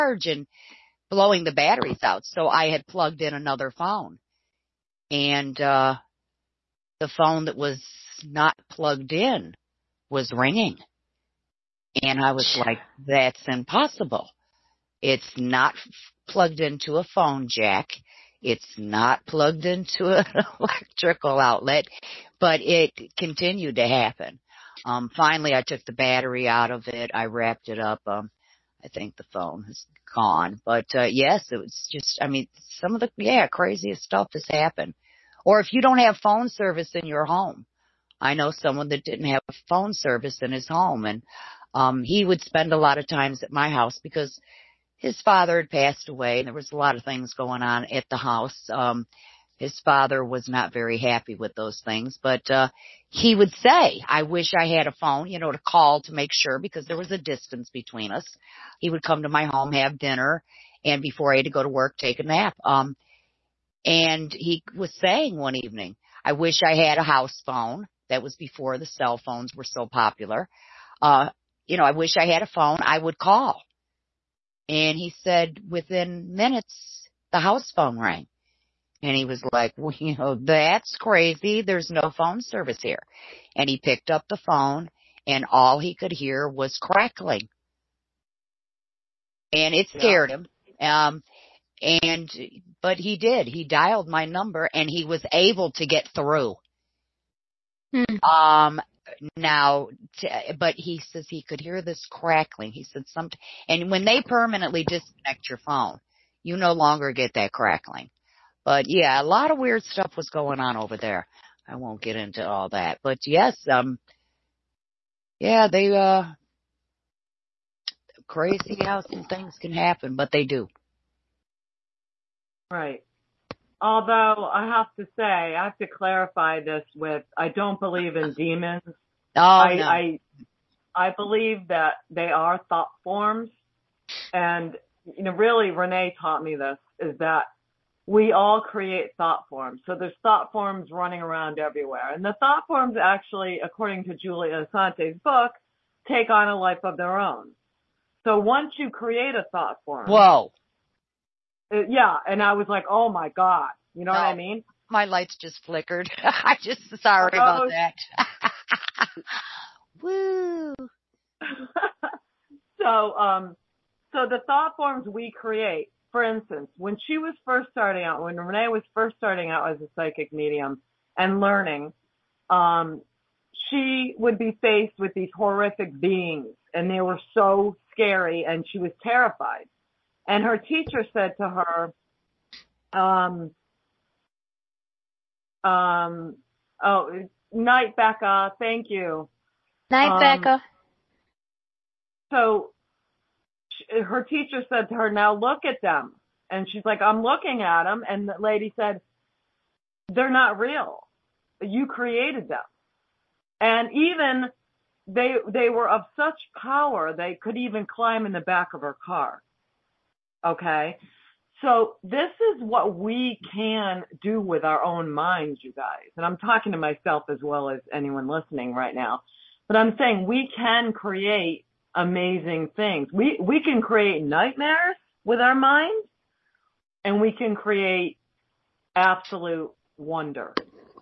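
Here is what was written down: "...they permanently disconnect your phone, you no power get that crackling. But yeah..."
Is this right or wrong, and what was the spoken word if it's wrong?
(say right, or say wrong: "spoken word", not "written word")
wrong: "longer", not "power".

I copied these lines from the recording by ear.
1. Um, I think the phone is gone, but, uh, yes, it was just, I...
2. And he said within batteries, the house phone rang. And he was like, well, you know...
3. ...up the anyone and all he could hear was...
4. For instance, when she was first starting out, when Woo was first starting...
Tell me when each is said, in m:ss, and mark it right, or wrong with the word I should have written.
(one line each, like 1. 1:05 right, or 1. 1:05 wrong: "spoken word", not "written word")
1. 0:28 right
2. 1:14 wrong: "minutes", not "batteries"
3. 1:24 wrong: "phone", not "anyone"
4. 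2:46 wrong: "Renee", not "Woo".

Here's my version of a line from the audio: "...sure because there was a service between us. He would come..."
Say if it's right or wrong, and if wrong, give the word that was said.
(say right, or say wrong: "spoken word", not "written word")
wrong: "distance", not "service".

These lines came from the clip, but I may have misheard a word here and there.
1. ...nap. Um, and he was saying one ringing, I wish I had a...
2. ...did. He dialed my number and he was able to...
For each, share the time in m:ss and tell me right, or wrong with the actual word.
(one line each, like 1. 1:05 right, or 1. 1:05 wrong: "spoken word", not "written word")
1. 1:02 wrong: "evening", not "ringing"
2. 1:33 right.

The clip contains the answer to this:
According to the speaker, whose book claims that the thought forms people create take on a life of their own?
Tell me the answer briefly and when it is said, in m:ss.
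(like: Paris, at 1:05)
Julia Assante, at 2:24.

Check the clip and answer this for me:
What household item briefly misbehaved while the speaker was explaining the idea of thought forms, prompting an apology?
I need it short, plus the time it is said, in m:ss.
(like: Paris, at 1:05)
Lights, at 2:35.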